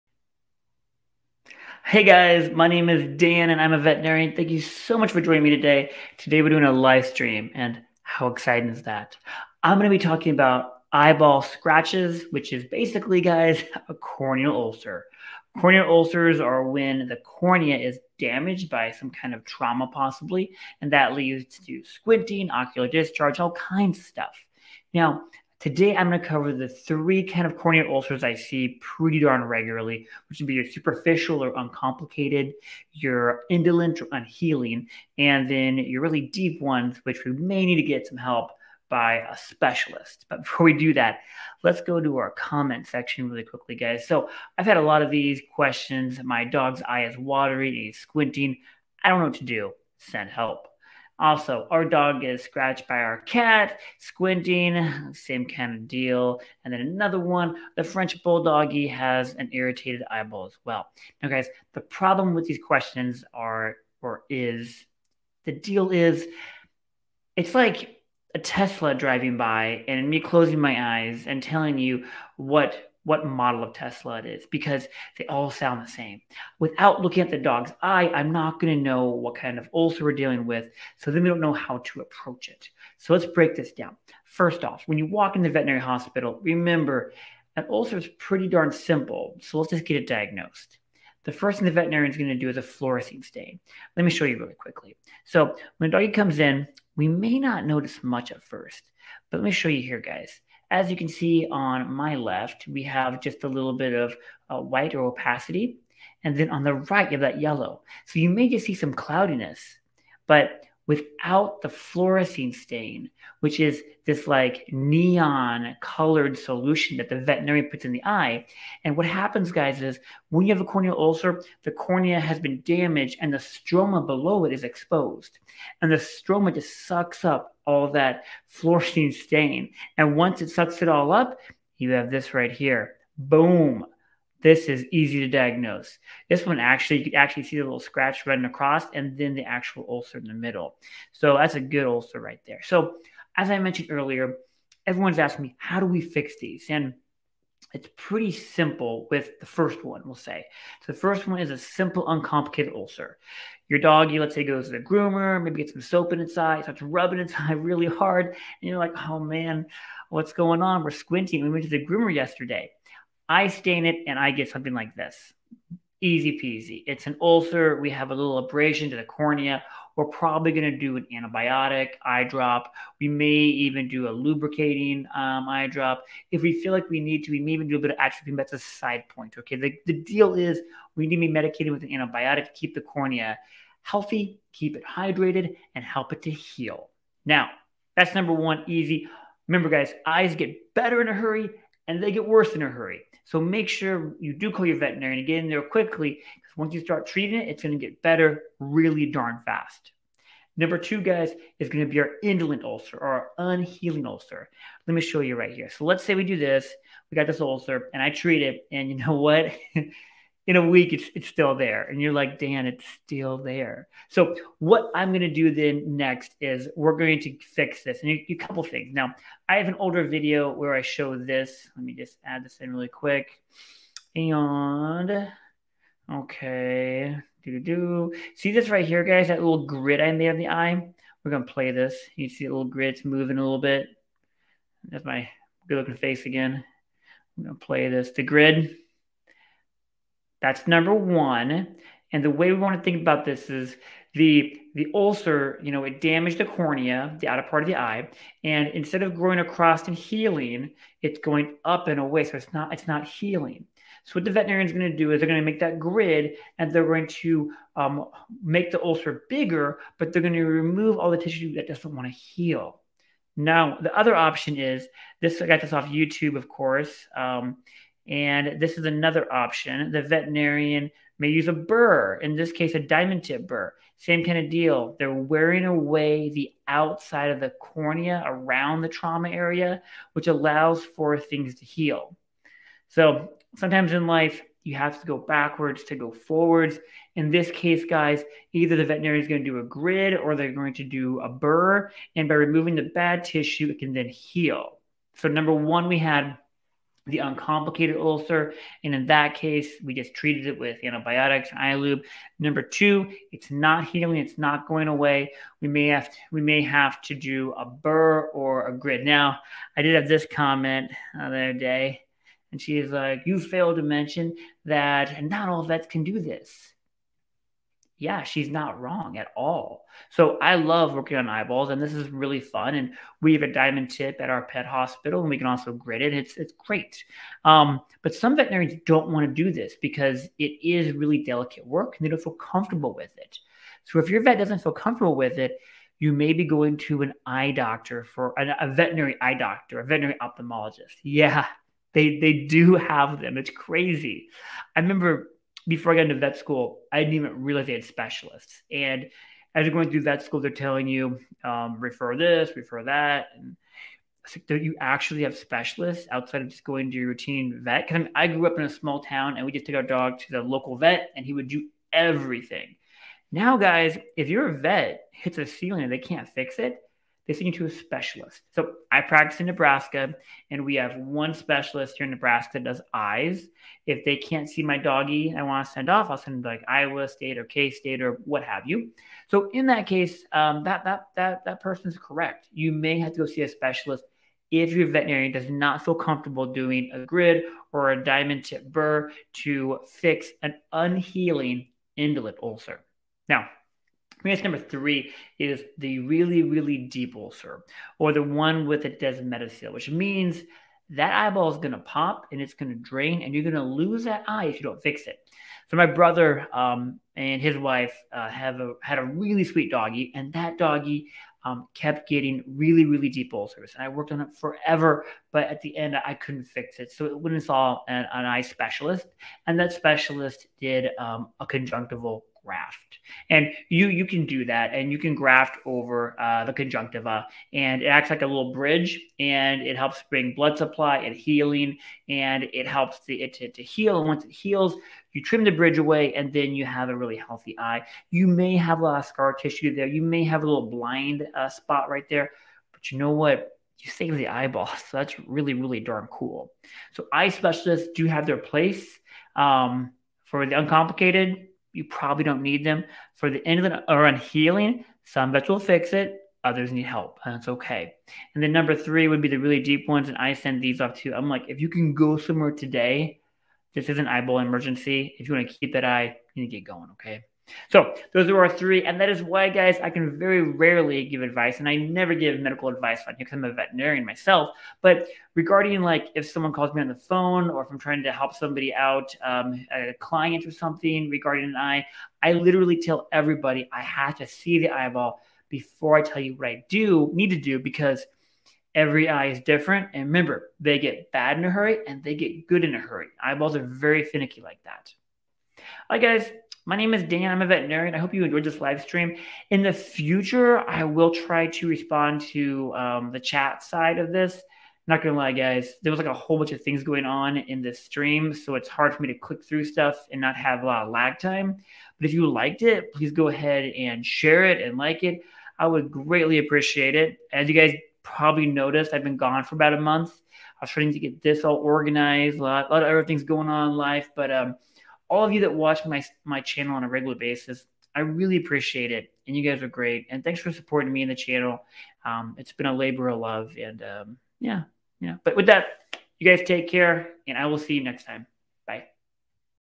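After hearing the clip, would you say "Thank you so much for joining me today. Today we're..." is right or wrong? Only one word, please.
right.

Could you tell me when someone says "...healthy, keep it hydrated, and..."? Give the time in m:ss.
3:03.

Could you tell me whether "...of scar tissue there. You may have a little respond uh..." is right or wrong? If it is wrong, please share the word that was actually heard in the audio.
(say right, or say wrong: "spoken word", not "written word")
wrong: "blind", not "respond".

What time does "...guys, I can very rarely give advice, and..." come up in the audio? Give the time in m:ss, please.
7:49.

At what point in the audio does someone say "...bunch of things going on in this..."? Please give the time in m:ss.
8:26.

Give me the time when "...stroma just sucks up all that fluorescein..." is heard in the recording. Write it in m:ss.
2:05.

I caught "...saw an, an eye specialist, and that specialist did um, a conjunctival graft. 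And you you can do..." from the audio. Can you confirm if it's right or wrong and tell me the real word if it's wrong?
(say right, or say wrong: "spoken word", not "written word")
right.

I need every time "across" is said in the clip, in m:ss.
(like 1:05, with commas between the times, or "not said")
2:18, 4:09.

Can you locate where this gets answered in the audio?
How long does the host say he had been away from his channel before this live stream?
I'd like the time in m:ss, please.
8:39.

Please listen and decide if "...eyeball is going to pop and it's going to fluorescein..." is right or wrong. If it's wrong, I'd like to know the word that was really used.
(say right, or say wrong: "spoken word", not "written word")
wrong: "drain", not "fluorescein".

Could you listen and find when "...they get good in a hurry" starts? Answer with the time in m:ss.
8:12.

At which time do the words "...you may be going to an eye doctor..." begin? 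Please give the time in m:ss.
5:35.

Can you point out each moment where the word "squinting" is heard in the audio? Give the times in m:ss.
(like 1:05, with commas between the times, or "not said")
0:21, 0:47, 0:53, 2:40.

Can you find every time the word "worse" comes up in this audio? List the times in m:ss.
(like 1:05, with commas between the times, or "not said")
3:12.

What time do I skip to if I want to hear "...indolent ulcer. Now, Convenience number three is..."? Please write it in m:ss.
6:31.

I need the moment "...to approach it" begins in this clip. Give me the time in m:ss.
1:21.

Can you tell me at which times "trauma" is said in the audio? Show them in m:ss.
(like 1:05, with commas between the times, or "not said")
0:19, 4:38.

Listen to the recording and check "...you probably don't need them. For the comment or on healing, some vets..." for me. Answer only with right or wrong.
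wrong.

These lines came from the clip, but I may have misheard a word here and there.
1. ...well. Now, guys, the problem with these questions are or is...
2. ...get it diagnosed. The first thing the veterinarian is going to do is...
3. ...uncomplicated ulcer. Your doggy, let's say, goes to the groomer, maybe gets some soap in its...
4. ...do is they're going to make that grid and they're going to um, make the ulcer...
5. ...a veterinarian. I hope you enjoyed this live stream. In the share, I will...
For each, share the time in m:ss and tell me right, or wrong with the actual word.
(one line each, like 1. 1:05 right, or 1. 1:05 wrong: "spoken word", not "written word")
1. 1:00 right
2. 1:29 right
3. 2:32 right
4. 4:14 right
5. 8:17 wrong: "future", not "share".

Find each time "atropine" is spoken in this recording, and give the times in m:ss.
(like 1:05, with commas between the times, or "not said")
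2:57.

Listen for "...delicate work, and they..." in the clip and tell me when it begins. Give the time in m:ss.
5:31.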